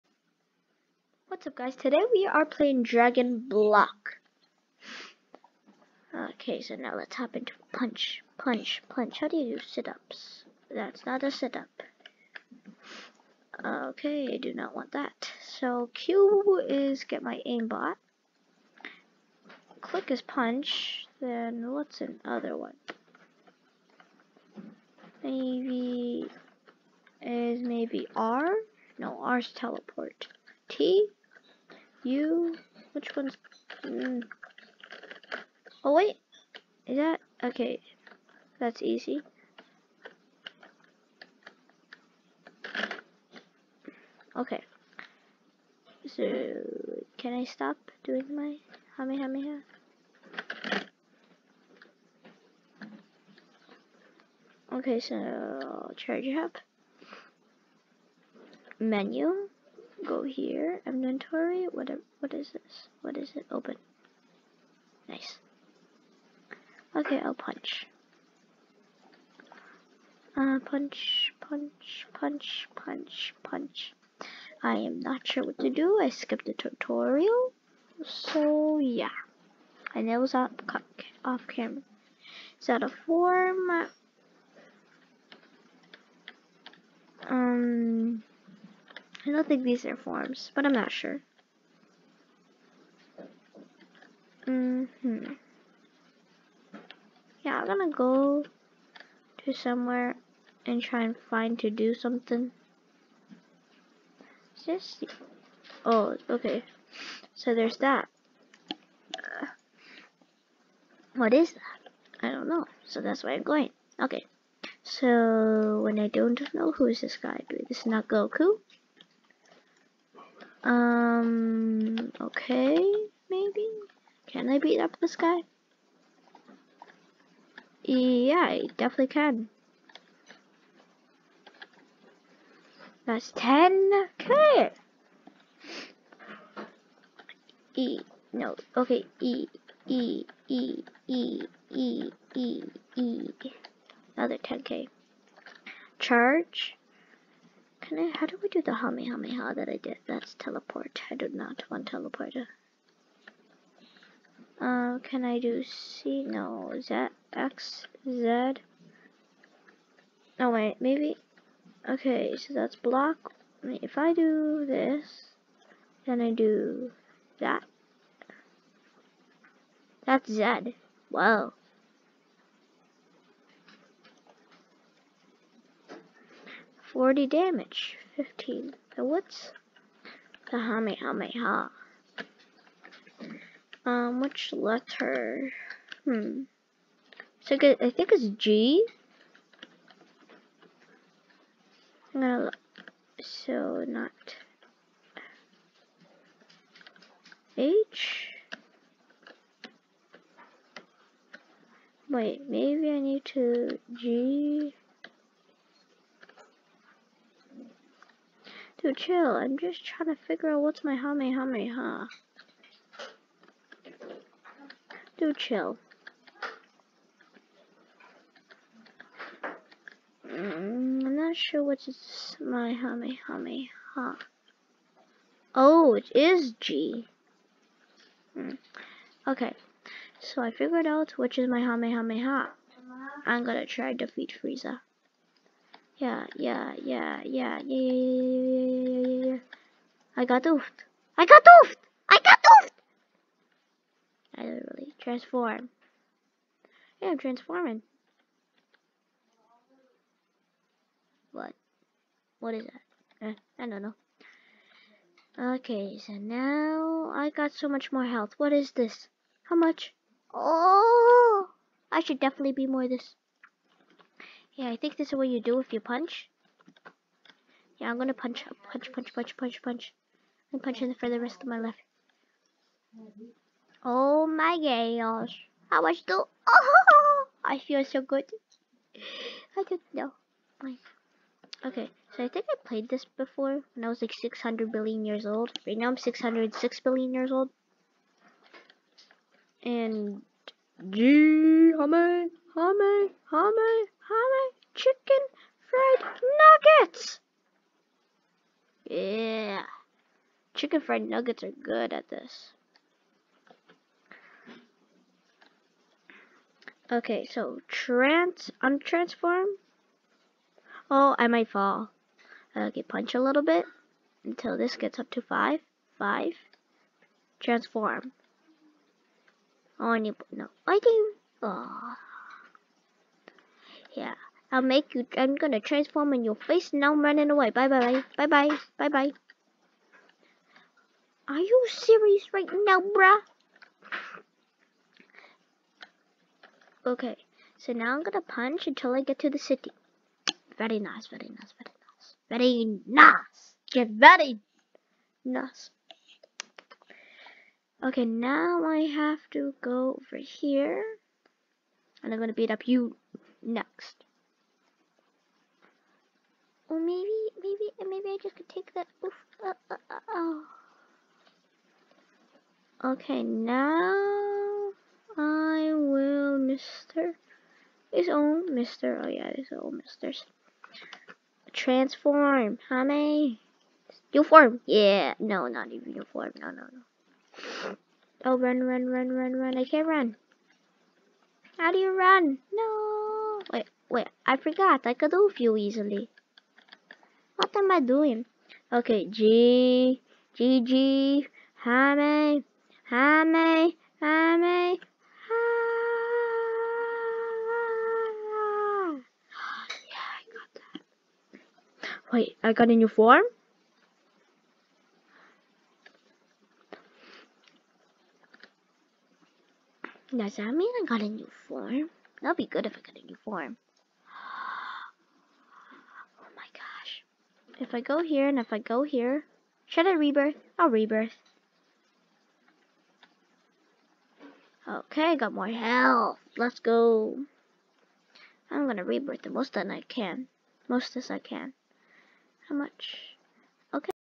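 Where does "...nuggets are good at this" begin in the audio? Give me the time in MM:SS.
05:01.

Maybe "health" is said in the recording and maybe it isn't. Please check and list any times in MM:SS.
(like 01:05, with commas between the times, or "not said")
04:18, 07:05.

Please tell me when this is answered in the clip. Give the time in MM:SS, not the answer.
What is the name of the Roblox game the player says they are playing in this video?
00:02.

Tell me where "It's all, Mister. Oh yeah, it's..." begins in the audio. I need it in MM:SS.
06:07.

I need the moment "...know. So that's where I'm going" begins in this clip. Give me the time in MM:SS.
01:52.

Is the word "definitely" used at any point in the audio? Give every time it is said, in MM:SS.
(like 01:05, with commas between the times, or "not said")
02:08, 04:22.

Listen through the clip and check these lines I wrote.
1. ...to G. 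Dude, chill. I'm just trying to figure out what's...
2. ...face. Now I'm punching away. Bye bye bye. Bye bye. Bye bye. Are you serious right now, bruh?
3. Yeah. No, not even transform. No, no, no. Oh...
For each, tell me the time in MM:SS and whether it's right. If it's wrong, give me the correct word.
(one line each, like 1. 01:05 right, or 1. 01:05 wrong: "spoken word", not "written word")
1. 03:23 right
2. 05:26 wrong: "running", not "punching"
3. 06:14 wrong: "uniform", not "transform".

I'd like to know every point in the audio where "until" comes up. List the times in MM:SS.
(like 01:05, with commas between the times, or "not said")
05:14, 05:38.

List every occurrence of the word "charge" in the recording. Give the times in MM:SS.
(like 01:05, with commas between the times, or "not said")
00:55, 02:25.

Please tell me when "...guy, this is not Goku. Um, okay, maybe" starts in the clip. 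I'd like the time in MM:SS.
01:57.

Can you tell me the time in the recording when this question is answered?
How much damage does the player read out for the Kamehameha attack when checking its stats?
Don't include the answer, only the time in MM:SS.
02:56.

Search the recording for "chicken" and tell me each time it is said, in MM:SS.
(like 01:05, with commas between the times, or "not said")
04:54, 05:00.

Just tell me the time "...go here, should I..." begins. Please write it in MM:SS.
06:58.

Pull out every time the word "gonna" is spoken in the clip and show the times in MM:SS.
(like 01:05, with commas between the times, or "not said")
01:37, 03:12, 03:53, 04:27, 05:25, 05:38, 05:52, 07:08.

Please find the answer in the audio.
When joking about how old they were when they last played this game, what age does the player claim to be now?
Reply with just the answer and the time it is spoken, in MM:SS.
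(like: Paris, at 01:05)
606 billion, at 04:45.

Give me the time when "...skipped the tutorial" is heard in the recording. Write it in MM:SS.
01:16.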